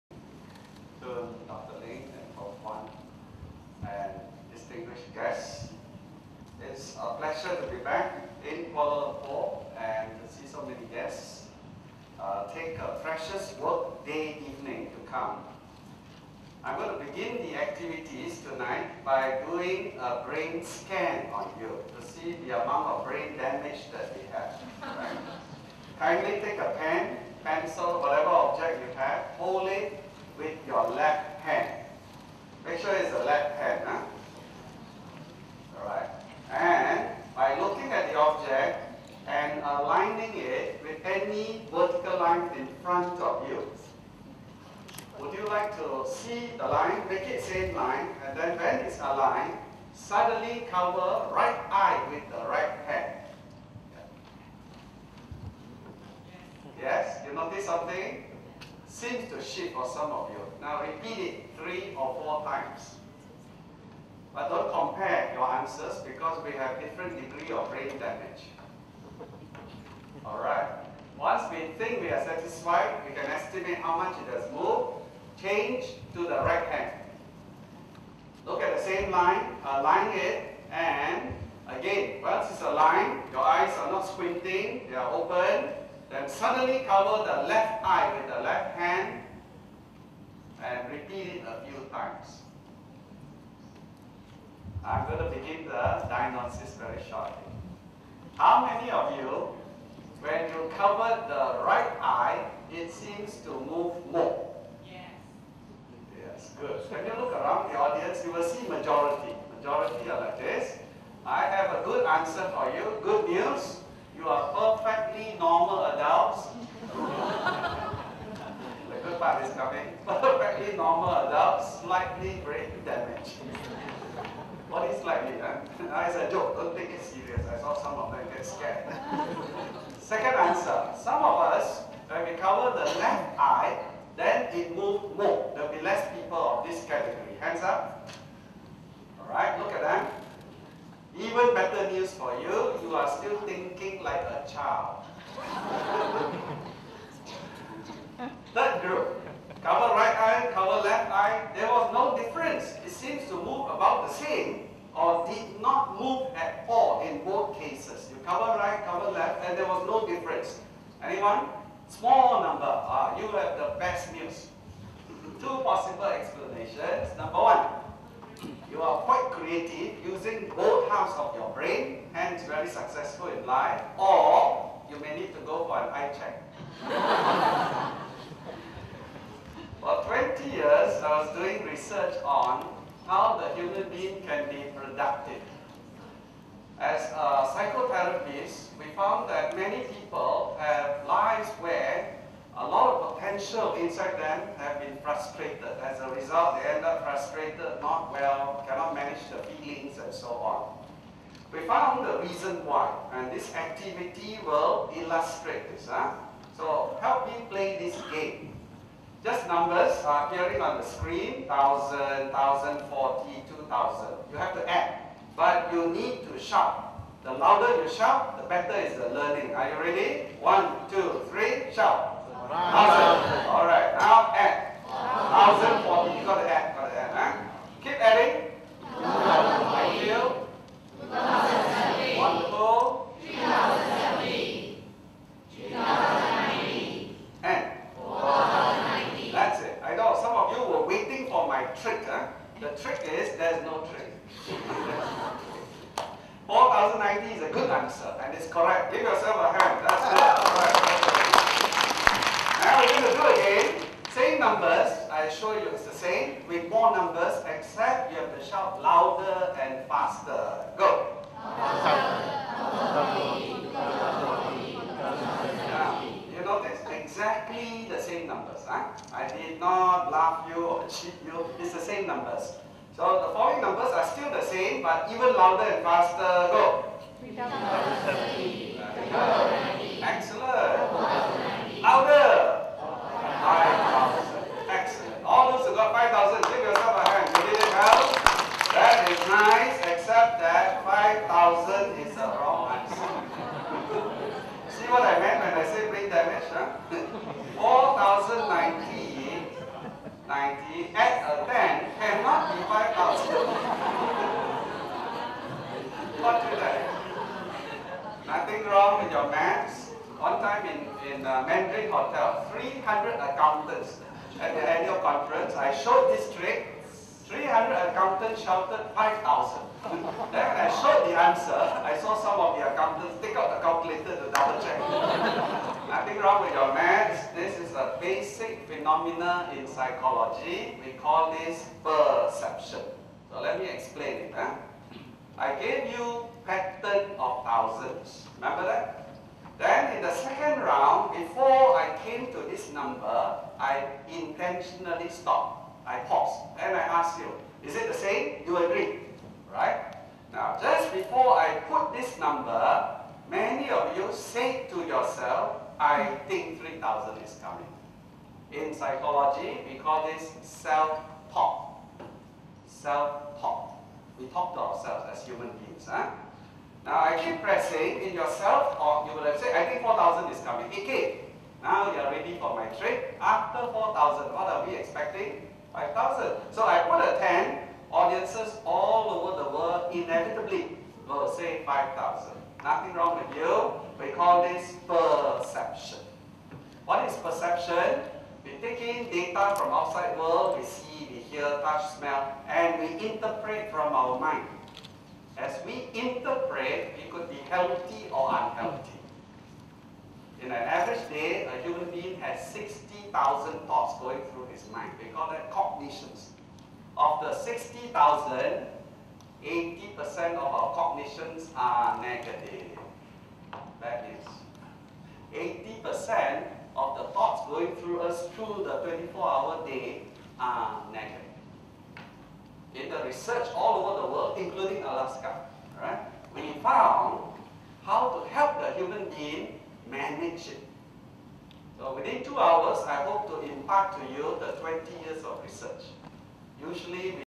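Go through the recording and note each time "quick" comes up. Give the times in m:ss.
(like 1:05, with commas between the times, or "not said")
not said.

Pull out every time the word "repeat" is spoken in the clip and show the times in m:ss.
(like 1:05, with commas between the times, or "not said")
1:00, 1:30.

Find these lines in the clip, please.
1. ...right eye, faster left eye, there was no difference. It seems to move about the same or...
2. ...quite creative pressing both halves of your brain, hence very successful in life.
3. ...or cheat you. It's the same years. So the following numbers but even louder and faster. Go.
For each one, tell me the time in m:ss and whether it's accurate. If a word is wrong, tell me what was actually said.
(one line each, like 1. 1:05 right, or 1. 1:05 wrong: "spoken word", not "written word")
1. 2:29 wrong: "cover", not "faster"
2. 2:49 wrong: "using", not "pressing"
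3. 4:30 wrong: "numbers", not "years".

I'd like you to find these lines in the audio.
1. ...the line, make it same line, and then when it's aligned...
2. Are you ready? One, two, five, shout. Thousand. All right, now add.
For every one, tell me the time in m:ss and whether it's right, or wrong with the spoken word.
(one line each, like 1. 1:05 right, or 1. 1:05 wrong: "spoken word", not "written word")
1. 0:46 right
2. 3:39 wrong: "three", not "five".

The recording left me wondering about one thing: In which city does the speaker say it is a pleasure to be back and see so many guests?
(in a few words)
Kuala Lumpur.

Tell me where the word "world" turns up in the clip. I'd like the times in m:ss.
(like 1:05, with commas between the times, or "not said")
6:19, 6:30, 7:04.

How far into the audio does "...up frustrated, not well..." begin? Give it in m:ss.
3:16.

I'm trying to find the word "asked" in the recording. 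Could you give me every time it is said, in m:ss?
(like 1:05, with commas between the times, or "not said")
5:46.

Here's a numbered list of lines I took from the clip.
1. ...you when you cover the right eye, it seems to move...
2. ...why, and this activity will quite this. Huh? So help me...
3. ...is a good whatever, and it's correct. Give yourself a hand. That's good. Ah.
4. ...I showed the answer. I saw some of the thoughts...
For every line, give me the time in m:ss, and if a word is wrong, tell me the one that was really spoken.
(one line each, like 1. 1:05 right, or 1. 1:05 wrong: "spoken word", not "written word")
1. 1:39 right
2. 3:22 wrong: "illustrate", not "quite"
3. 4:07 wrong: "answer", not "whatever"
4. 5:20 wrong: "accountants", not "thoughts".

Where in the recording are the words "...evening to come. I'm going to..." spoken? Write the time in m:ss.
0:14.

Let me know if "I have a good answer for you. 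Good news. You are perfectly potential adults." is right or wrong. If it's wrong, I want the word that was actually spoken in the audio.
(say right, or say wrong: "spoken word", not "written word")
wrong: "normal", not "potential".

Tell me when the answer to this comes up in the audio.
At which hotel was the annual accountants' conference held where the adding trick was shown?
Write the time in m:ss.
5:11.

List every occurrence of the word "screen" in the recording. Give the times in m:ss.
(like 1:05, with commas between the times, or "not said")
3:30.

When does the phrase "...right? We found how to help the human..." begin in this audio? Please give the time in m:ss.
7:05.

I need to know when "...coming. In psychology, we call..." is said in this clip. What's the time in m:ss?
5:57.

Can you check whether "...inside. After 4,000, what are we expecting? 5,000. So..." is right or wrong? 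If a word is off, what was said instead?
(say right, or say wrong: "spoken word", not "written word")
wrong: "trade", not "inside".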